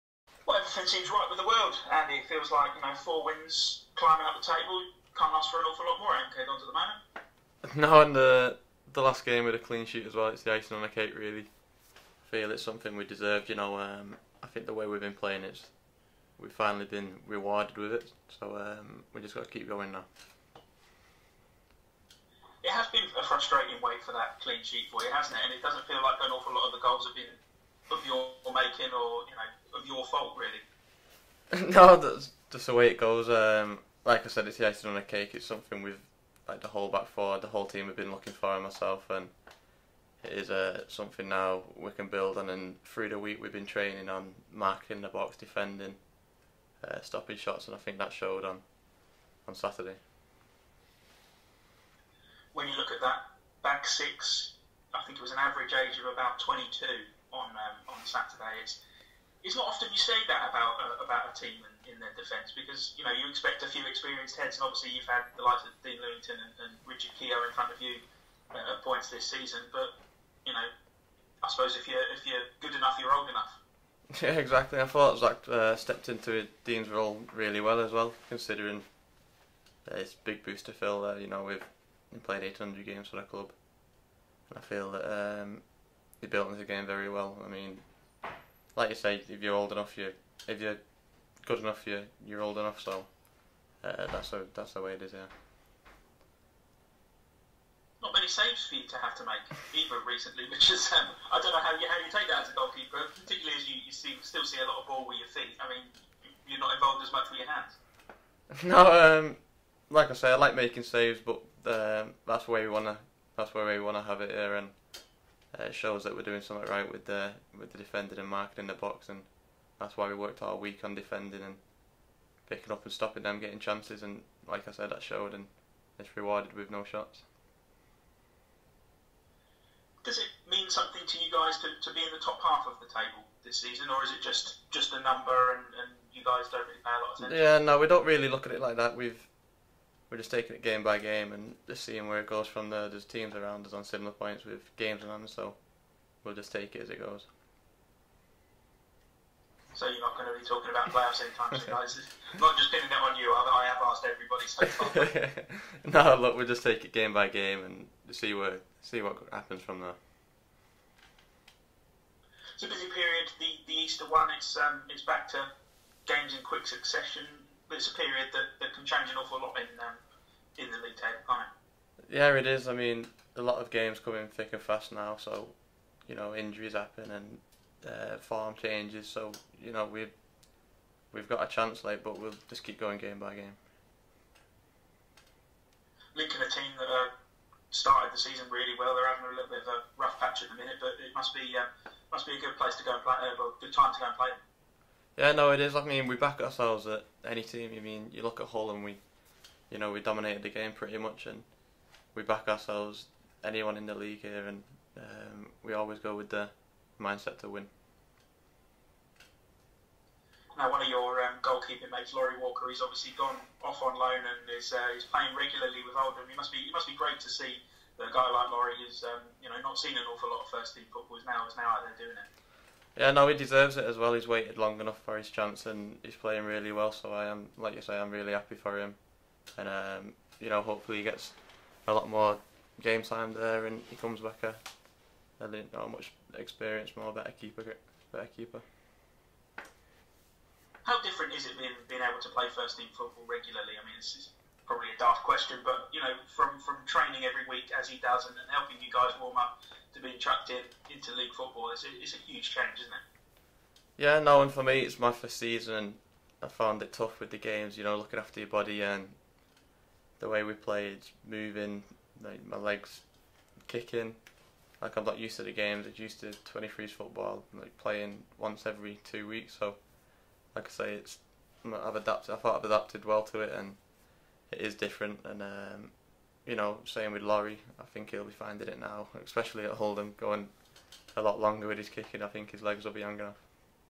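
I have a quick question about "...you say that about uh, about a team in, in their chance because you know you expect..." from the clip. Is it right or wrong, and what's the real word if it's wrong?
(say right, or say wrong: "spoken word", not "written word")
wrong: "defence", not "chance".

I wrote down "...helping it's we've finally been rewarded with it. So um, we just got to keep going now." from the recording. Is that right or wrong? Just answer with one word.
wrong.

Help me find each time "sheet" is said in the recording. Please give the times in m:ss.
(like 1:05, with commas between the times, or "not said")
0:09, 0:24.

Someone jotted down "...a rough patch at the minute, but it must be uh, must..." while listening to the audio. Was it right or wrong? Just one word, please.
right.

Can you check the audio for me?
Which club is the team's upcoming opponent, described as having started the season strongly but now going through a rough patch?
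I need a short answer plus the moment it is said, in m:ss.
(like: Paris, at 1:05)
Lincoln, at 3:06.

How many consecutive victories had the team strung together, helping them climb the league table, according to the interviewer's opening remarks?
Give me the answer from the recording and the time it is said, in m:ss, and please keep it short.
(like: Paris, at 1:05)
4, at 0:02.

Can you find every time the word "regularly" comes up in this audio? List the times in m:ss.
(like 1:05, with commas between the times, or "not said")
3:35, 4:03.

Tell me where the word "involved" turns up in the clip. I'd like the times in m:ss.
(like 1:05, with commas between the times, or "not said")
1:46.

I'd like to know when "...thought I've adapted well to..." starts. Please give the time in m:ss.
4:32.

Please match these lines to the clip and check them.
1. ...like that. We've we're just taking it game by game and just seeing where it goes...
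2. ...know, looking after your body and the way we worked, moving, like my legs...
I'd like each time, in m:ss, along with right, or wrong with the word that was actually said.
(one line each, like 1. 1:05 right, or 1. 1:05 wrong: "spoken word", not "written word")
1. 2:18 right
2. 4:17 wrong: "played", not "worked".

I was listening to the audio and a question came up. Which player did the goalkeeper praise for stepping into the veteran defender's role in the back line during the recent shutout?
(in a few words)
Zach.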